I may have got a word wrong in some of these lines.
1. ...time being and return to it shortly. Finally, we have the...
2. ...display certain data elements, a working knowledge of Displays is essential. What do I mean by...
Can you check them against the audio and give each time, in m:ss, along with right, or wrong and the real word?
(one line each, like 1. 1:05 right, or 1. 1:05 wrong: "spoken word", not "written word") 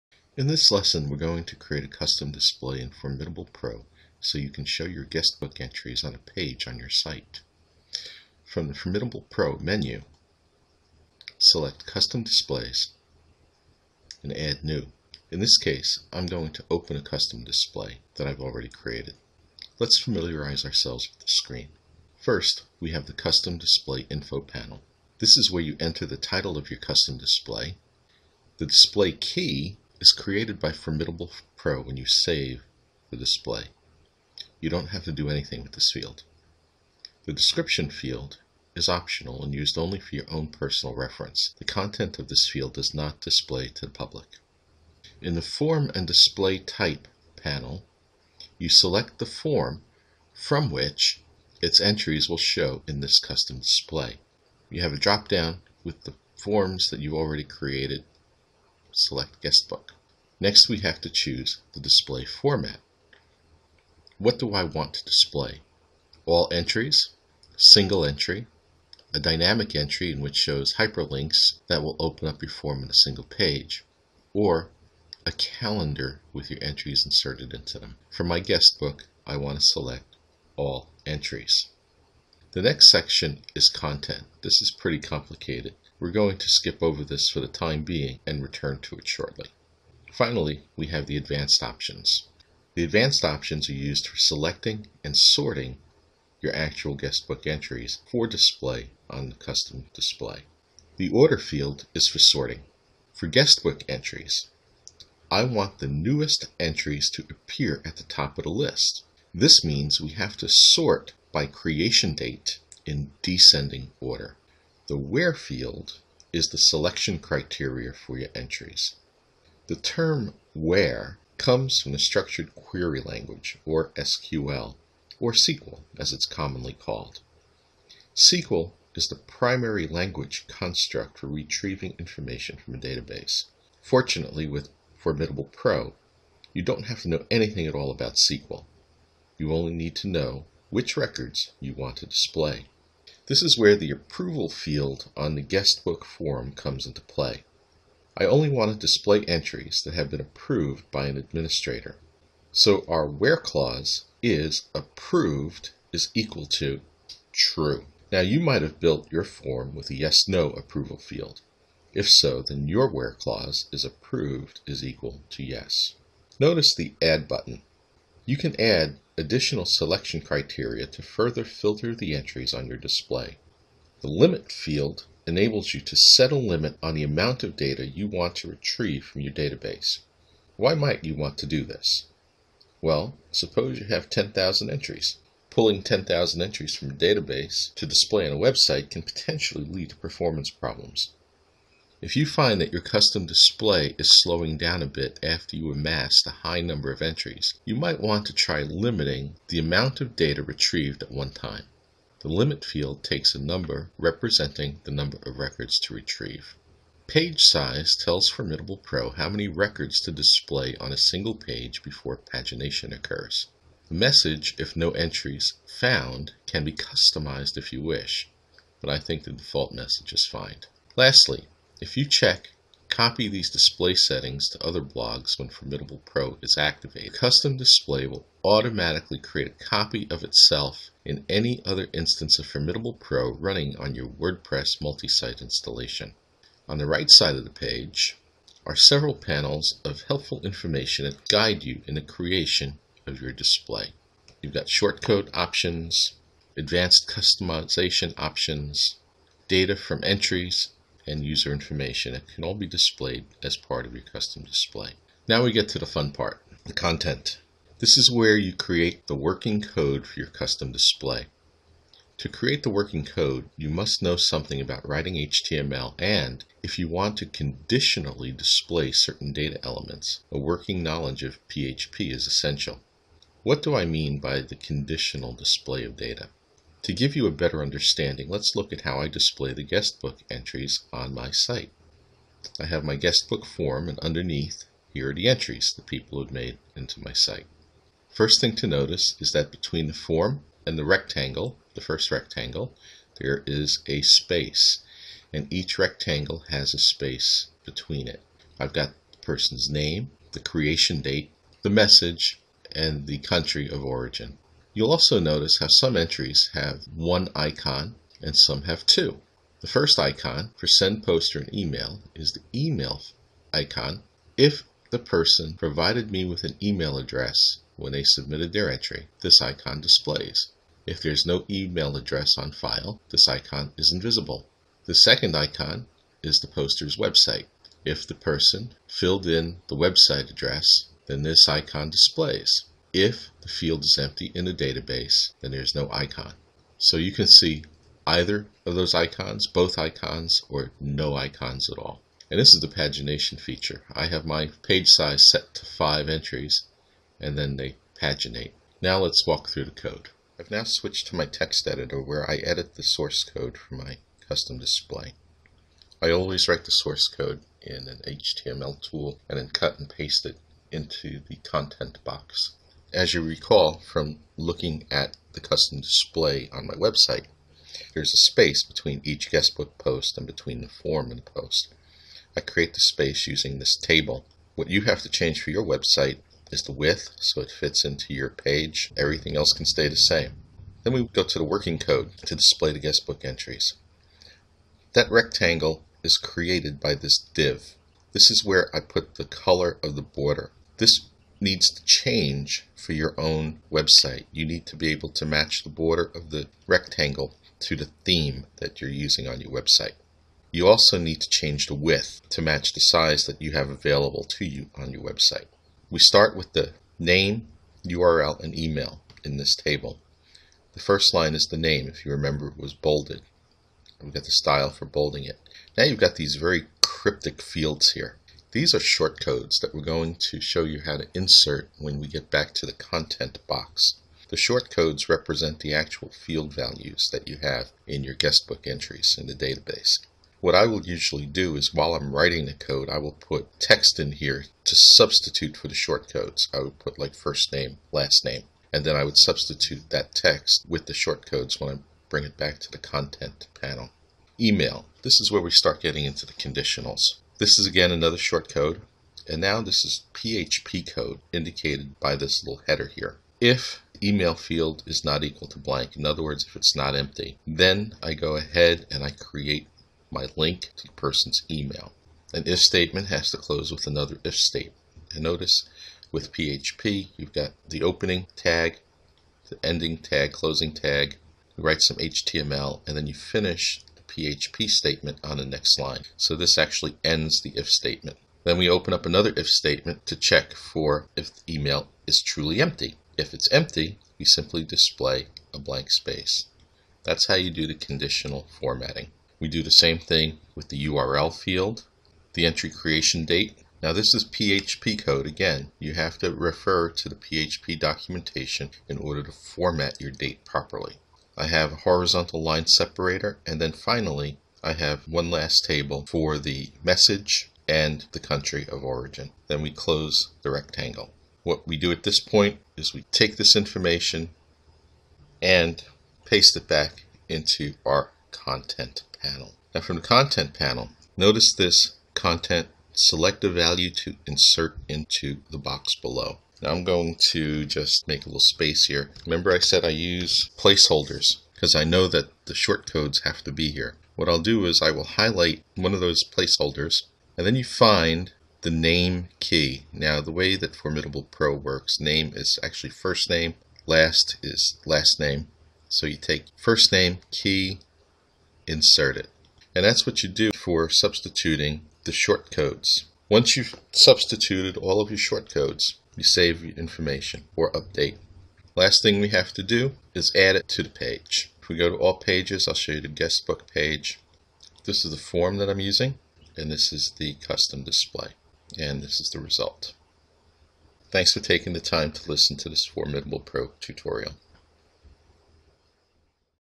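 1. 1:27 right
2. 4:28 wrong: "PHP", not "Displays".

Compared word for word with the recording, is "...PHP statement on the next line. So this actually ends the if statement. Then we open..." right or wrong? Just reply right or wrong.
right.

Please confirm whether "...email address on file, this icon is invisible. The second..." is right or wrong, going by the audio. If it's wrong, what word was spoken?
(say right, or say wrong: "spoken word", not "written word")
right.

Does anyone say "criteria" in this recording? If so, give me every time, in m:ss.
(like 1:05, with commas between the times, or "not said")
1:57, 2:50.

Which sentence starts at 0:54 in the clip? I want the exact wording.
You have a drop-down with the forms that you've already created select guestbook.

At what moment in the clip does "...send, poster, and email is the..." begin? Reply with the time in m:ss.
5:10.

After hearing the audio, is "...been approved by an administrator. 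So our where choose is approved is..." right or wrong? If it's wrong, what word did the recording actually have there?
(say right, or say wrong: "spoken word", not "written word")
wrong: "clause", not "choose".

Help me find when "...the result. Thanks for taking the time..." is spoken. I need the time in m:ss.
9:29.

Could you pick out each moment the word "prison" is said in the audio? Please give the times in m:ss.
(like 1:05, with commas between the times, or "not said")
not said.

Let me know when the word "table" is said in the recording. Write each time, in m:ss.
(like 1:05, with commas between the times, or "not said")
6:13, 6:49, 8:25.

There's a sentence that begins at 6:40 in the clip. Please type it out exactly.
You also need to change the width to match the size that you have available to you on your website.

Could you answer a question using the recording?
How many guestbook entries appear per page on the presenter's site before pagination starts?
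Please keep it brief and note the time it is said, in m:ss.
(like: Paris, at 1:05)
5, at 5:45.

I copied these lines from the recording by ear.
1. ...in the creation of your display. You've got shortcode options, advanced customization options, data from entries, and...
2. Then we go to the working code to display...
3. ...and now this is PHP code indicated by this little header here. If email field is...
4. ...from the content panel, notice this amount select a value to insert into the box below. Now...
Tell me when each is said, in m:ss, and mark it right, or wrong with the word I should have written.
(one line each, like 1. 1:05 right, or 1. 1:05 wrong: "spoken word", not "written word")
1. 4:01 right
2. 6:20 right
3. 7:29 right
4. 8:39 wrong: "content", not "amount".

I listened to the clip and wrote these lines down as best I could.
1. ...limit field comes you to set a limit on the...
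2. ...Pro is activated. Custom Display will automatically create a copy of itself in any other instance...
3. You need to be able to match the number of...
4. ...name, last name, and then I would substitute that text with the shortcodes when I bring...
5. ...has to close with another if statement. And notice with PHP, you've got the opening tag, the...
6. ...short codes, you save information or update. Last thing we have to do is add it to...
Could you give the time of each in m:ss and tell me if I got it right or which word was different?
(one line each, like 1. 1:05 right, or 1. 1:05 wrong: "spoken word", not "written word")
1. 2:54 wrong: "enables", not "comes"
2. 3:46 right
3. 6:34 wrong: "border", not "number"
4. 7:17 right
5. 7:43 right
6. 9:15 right.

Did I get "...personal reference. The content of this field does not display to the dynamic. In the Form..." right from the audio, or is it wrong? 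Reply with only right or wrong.
wrong.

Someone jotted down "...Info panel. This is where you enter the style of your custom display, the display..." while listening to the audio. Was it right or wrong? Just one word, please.
wrong.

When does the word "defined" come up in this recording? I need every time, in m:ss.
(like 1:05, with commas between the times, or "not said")
not said.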